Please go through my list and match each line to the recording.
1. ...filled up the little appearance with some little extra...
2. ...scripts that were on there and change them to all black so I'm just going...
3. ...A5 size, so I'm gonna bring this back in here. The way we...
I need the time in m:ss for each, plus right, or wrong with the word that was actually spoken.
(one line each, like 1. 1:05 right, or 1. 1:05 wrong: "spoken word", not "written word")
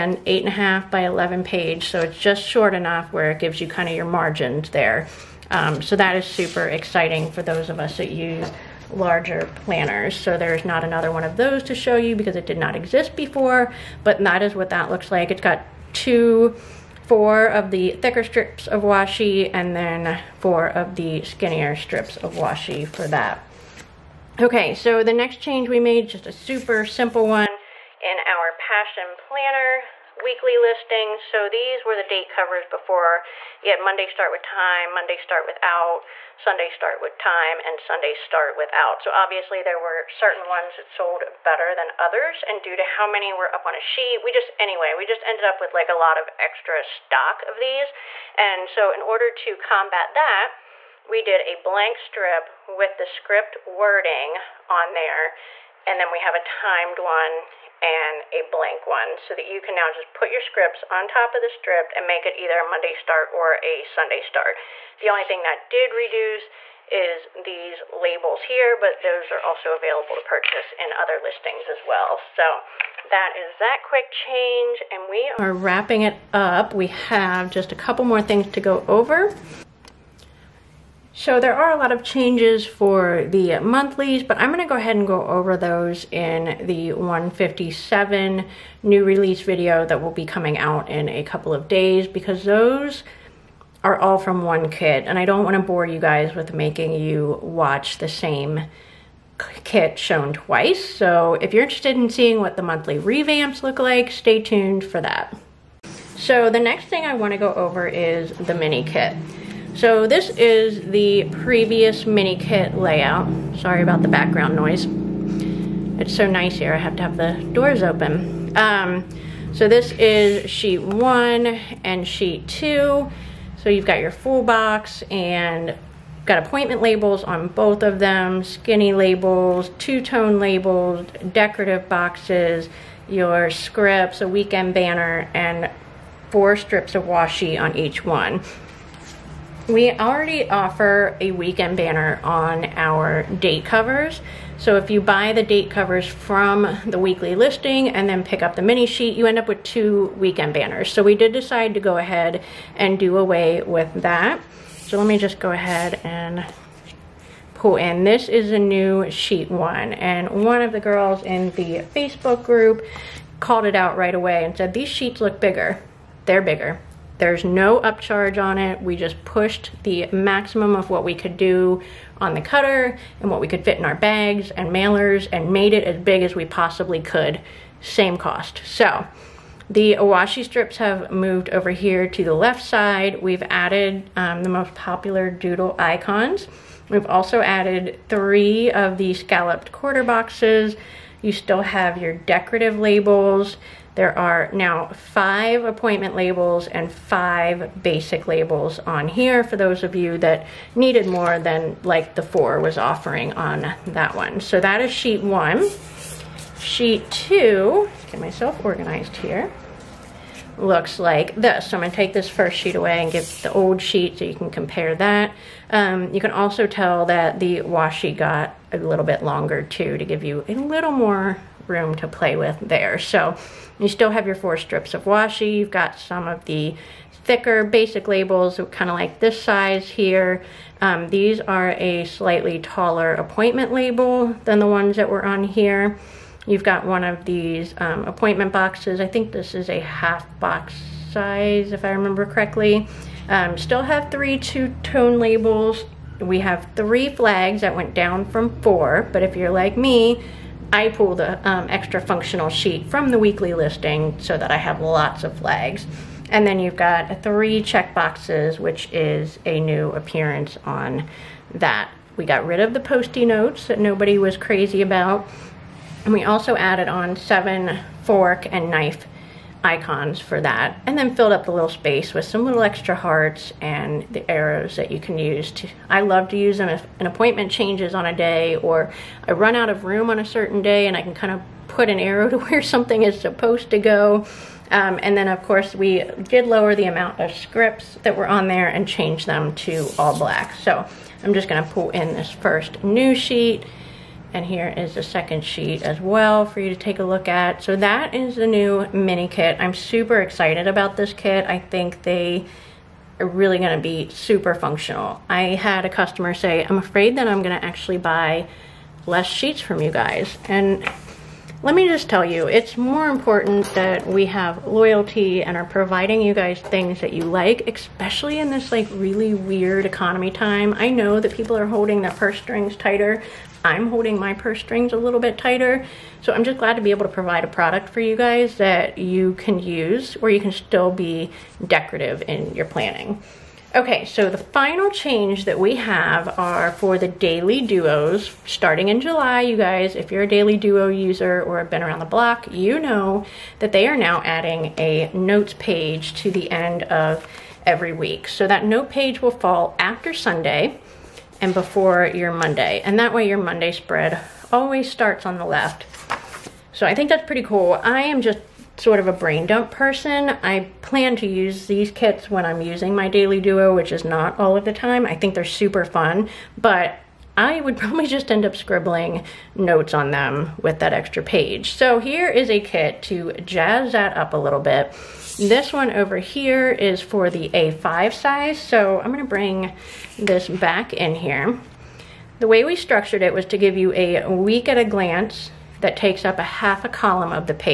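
1. 4:31 wrong: "space", not "appearance"
2. 4:47 right
3. 6:17 right.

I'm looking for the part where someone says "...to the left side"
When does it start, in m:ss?
3:02.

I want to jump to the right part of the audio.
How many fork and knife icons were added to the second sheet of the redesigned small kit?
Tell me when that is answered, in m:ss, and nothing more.
4:27.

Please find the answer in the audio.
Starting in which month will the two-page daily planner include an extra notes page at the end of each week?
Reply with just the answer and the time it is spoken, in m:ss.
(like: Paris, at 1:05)
July, at 5:38.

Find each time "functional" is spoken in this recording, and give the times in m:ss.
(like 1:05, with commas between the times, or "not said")
4:12, 5:04.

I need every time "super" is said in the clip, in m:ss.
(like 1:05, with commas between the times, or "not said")
0:06, 0:26, 4:59, 5:04, 6:05.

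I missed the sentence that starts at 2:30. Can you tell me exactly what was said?
So we did decide to go ahead and do away with that.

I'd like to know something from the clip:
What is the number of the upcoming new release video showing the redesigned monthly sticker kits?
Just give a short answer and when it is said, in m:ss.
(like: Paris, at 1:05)
157, at 1:26.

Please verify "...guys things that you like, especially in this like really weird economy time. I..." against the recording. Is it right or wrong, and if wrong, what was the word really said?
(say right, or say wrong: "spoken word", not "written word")
right.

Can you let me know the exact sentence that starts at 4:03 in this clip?
Um, still have three two-tone labels.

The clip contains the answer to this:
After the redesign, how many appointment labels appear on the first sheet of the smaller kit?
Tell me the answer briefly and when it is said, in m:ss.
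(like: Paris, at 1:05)
5, at 3:14.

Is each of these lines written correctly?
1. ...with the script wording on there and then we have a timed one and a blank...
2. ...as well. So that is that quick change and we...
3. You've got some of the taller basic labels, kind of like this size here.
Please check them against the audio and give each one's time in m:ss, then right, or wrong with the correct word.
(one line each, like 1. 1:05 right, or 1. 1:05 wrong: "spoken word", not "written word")
1. 0:52 right
2. 1:11 right
3. 3:45 wrong: "thicker", not "taller".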